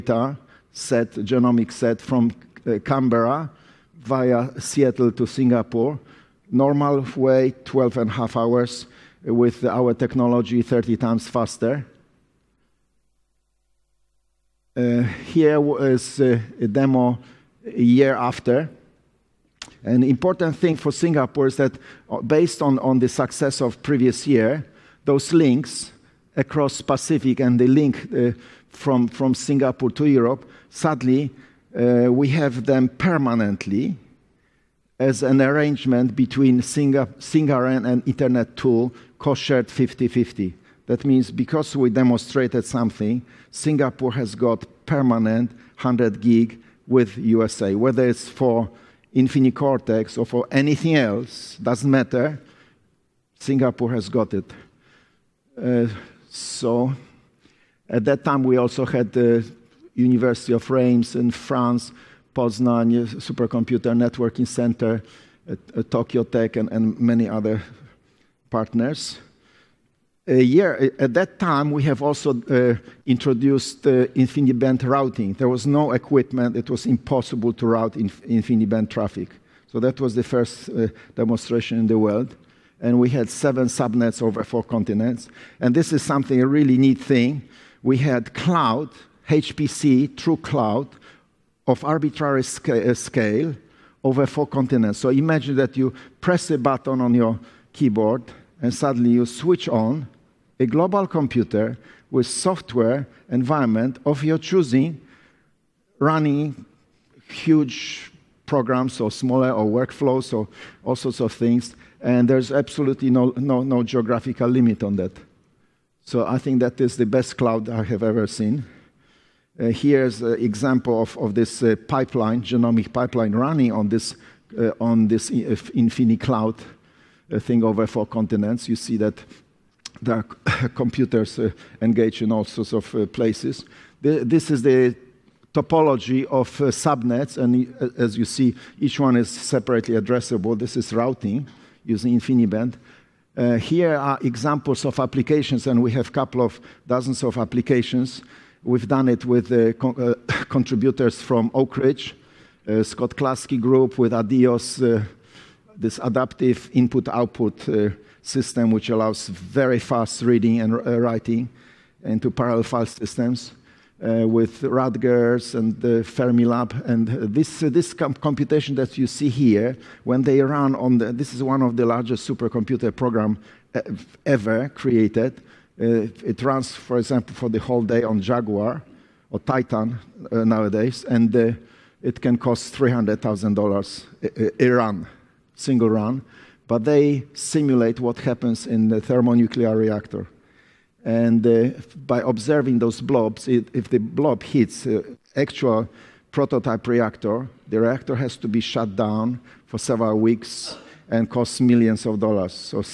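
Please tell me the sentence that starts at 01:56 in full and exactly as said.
So I think that is the best cloud I have ever seen.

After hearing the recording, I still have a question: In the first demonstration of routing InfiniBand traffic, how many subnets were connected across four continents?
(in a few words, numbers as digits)
7.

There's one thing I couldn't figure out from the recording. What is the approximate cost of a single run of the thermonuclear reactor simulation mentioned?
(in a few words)
$300,000.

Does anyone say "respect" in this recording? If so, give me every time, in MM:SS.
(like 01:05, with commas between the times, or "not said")
not said.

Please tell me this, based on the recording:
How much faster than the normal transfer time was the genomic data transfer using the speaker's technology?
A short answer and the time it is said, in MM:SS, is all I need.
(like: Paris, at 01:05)
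30 times faster, at 00:10.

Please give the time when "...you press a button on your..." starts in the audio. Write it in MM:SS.
01:35.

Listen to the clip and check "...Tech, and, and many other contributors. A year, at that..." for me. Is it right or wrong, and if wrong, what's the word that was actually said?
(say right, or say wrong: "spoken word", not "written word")
wrong: "partners", not "contributors".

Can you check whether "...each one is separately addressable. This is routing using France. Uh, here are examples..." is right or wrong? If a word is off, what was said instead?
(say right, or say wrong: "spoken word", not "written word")
wrong: "InfiniBand", not "France".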